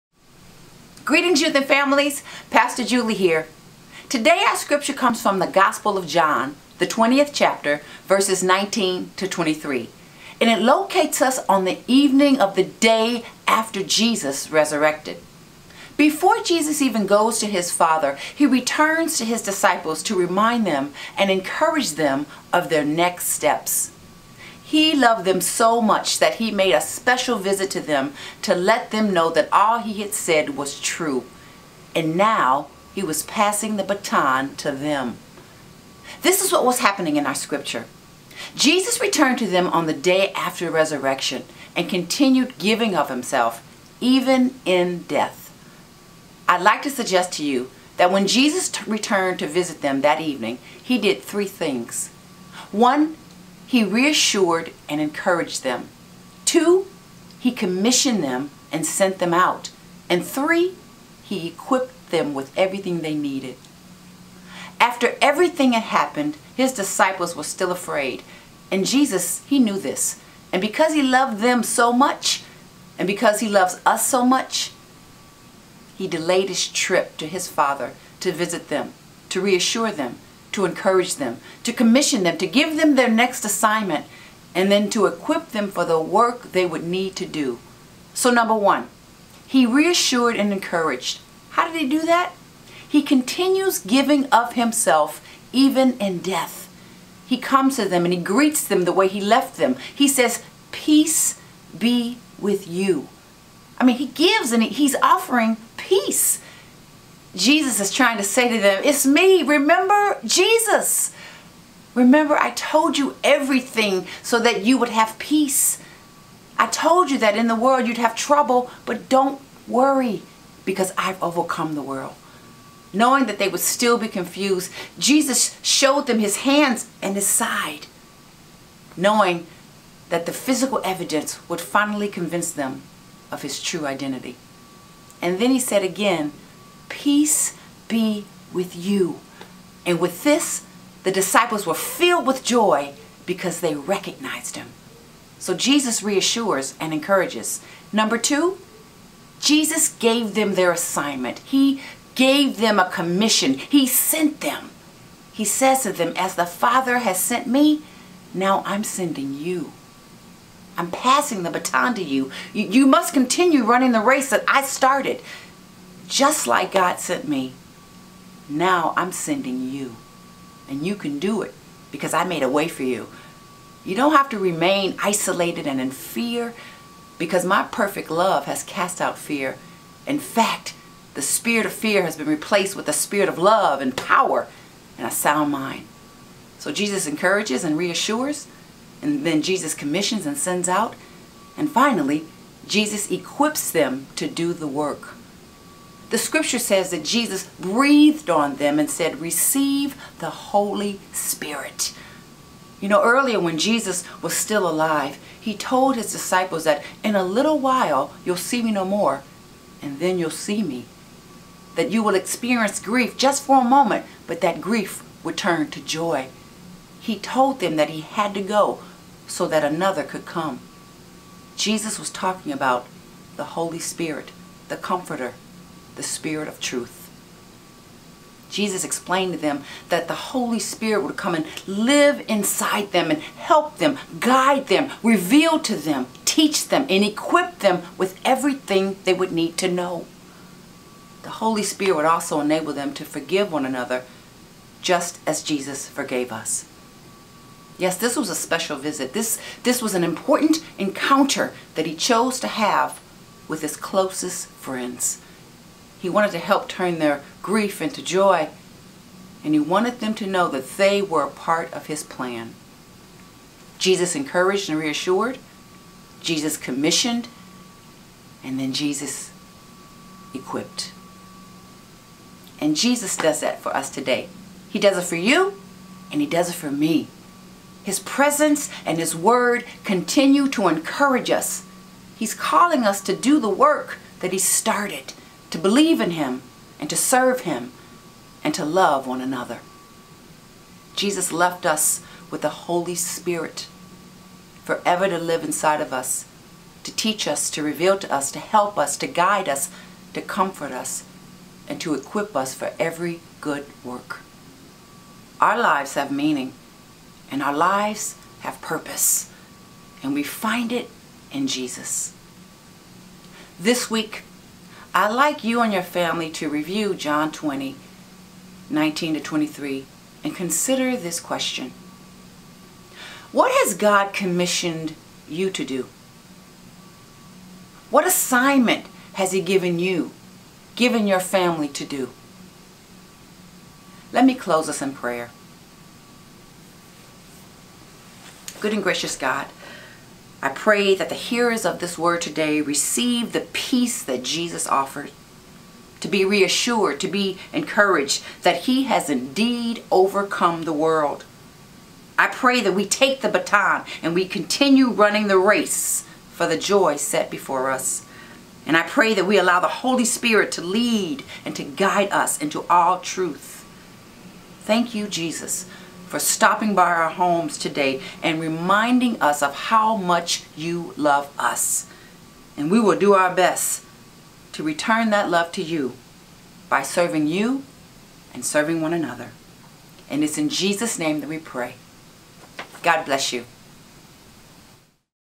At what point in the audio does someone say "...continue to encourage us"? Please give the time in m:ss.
4:39.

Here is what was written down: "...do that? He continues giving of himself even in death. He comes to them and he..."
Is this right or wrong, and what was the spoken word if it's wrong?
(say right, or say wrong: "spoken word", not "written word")
right.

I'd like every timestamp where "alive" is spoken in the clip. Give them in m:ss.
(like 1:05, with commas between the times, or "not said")
3:24.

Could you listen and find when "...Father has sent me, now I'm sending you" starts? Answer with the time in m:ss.
2:36.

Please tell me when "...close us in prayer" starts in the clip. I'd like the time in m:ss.
5:34.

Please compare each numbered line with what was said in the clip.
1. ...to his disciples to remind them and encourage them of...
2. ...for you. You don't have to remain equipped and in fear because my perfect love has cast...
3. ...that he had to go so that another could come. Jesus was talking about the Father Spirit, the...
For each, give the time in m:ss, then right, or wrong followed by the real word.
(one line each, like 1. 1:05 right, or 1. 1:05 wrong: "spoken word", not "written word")
1. 0:19 right
2. 2:52 wrong: "isolated", not "equipped"
3. 3:37 wrong: "Holy", not "Father".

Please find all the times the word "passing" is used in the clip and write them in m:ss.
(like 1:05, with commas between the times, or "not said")
0:33, 2:40.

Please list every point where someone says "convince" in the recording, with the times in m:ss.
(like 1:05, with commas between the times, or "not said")
2:12.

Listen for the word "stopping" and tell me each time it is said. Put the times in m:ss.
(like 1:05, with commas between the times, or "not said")
6:06.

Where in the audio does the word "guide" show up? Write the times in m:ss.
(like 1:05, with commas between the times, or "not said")
3:54, 4:59, 6:01.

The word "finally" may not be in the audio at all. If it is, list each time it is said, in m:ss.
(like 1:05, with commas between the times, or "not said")
2:11, 3:11.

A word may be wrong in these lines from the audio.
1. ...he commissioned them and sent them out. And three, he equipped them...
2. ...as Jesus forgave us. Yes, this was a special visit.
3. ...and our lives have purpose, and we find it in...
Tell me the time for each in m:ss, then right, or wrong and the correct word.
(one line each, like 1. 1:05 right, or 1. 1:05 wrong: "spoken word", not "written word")
1. 0:57 right
2. 4:05 right
3. 5:07 right.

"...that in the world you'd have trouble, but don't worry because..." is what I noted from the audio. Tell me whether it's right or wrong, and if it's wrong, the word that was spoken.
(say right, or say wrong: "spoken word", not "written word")
right.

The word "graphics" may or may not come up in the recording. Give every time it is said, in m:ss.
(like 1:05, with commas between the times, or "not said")
not said.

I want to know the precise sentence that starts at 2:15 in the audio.
And then he said again, peace be with you.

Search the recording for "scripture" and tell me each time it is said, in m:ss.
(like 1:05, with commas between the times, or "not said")
0:04, 0:37, 3:16.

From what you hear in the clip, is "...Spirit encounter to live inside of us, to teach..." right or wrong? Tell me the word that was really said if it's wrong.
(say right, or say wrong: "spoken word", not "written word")
wrong: "forever", not "encounter".